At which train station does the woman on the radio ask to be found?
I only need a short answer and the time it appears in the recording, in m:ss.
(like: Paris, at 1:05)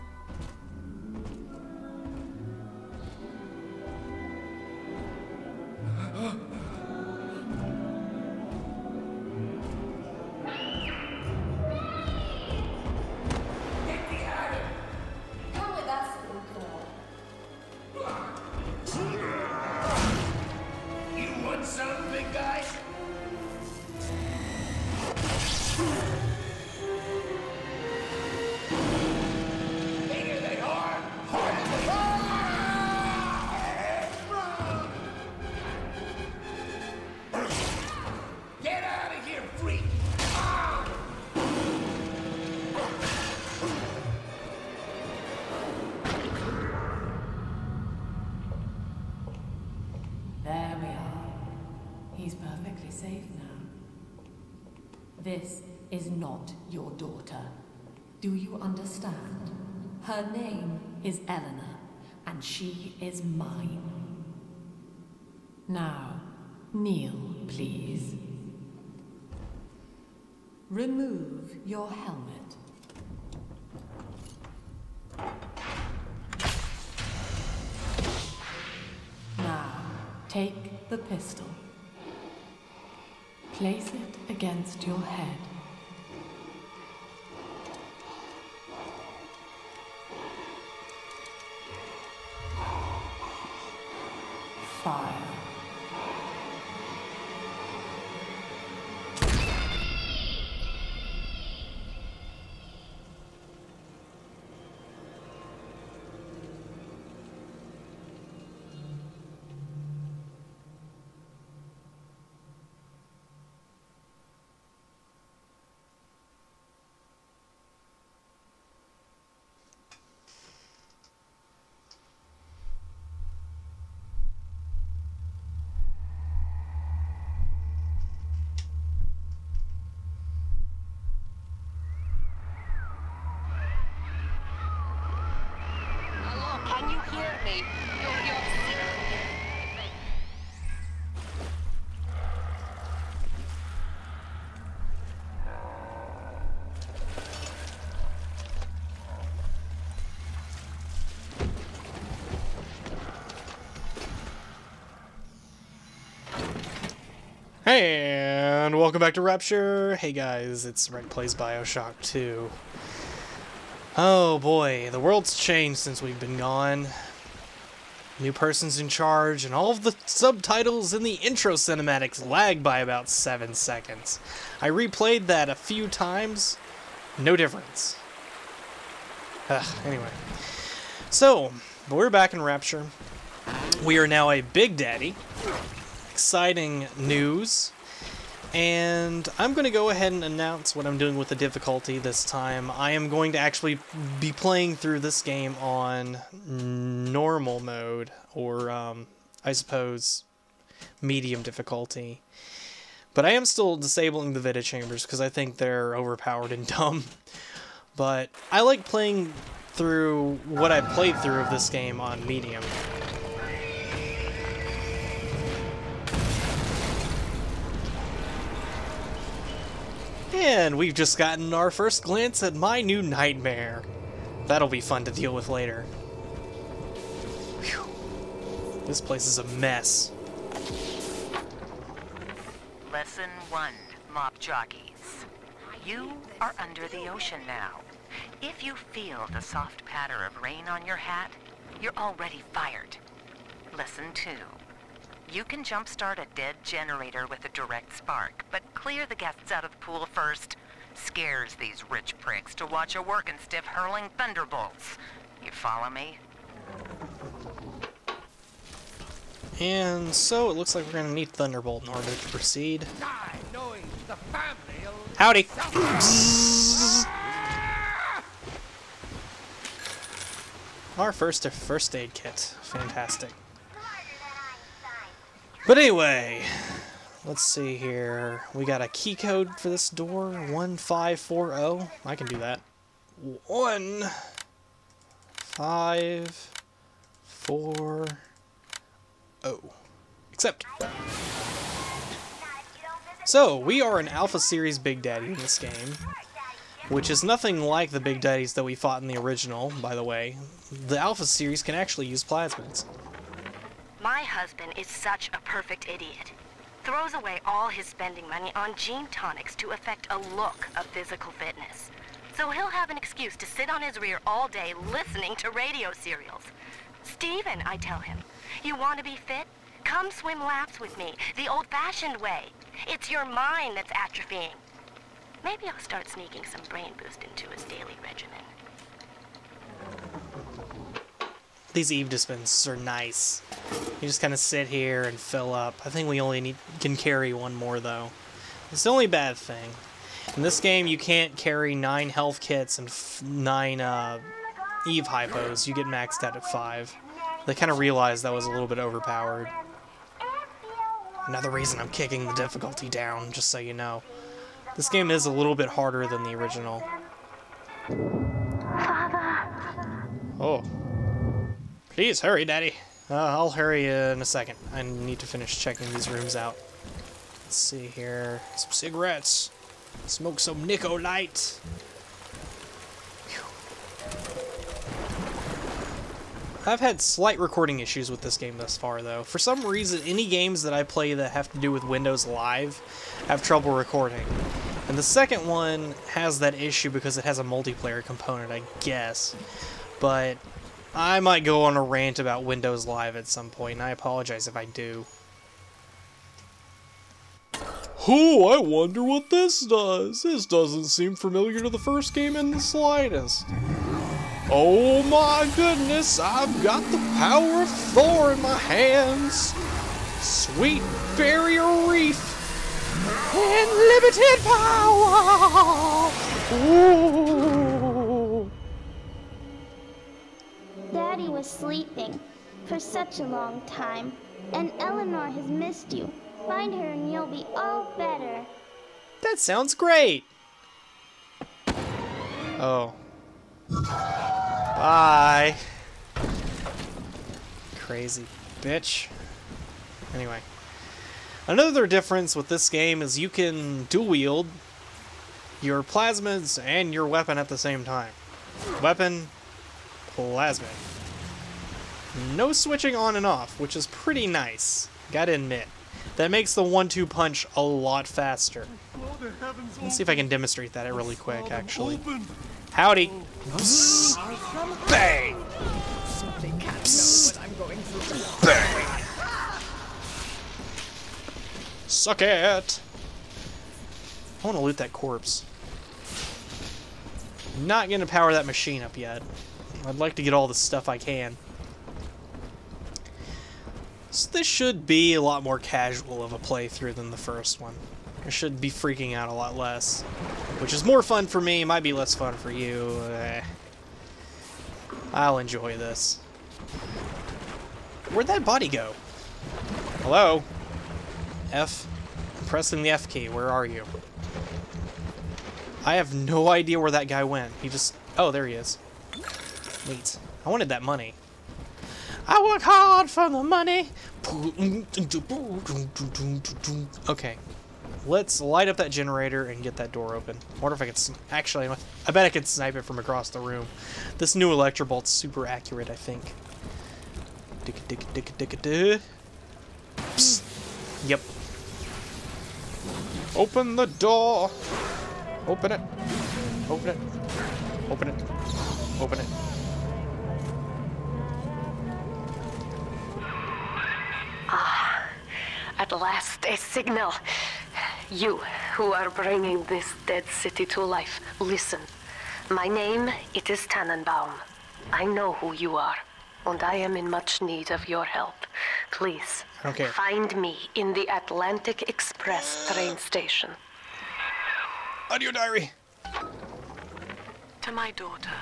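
Atlantic Express, at 9:21.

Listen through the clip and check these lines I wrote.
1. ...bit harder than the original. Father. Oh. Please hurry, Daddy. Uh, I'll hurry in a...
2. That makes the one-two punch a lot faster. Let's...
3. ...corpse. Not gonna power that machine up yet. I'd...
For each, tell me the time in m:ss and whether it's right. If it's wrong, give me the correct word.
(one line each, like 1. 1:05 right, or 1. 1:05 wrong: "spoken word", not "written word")
1. 5:55 right
2. 7:36 right
3. 7:54 right.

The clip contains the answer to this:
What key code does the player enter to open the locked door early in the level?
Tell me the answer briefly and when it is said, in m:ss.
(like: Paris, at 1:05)
1540, at 4:40.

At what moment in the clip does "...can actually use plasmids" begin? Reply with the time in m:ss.
5:01.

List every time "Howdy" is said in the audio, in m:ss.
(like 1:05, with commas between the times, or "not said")
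4:25, 7:42.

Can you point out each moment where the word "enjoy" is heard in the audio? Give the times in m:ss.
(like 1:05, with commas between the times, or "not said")
8:15.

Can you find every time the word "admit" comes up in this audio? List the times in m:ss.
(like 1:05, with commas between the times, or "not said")
7:35.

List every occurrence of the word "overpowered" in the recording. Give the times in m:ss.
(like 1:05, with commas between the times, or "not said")
3:25, 5:48.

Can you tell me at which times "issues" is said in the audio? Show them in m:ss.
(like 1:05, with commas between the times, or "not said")
6:17, 6:26.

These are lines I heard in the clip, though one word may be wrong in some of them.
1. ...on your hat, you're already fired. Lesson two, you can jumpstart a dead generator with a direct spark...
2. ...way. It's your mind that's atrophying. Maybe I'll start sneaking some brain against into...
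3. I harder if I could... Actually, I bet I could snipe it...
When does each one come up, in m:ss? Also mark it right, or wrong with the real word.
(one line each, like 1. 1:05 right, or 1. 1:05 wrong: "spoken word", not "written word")
1. 4:00 right
2. 5:22 wrong: "boost", not "against"
3. 8:40 wrong: "wonder", not "harder".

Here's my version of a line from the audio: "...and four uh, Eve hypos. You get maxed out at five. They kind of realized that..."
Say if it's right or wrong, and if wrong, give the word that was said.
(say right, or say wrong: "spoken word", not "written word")
wrong: "nine", not "four".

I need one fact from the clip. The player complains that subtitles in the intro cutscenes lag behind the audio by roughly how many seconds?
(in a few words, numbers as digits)
7.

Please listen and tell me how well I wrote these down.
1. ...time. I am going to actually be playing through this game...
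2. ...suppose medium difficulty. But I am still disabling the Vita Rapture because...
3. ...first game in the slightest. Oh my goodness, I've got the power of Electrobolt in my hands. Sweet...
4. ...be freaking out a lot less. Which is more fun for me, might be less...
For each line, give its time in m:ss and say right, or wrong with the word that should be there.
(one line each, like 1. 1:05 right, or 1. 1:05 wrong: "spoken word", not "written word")
1. 3:12 right
2. 3:19 wrong: "Chambers", not "Rapture"
3. 6:41 wrong: "Thor", not "Electrobolt"
4. 8:08 right.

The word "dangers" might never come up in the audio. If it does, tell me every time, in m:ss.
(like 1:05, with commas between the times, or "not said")
not said.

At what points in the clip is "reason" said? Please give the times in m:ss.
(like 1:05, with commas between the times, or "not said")
5:51, 6:19.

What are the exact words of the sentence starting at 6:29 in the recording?
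But I might go on a rant about Windows Live at some point, and I apologize if I do.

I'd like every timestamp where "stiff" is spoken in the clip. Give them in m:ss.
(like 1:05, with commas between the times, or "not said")
4:13.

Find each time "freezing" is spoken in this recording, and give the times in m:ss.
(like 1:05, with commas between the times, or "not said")
not said.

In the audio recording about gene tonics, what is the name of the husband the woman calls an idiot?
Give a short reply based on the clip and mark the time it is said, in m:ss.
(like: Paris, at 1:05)
Steven, at 5:17.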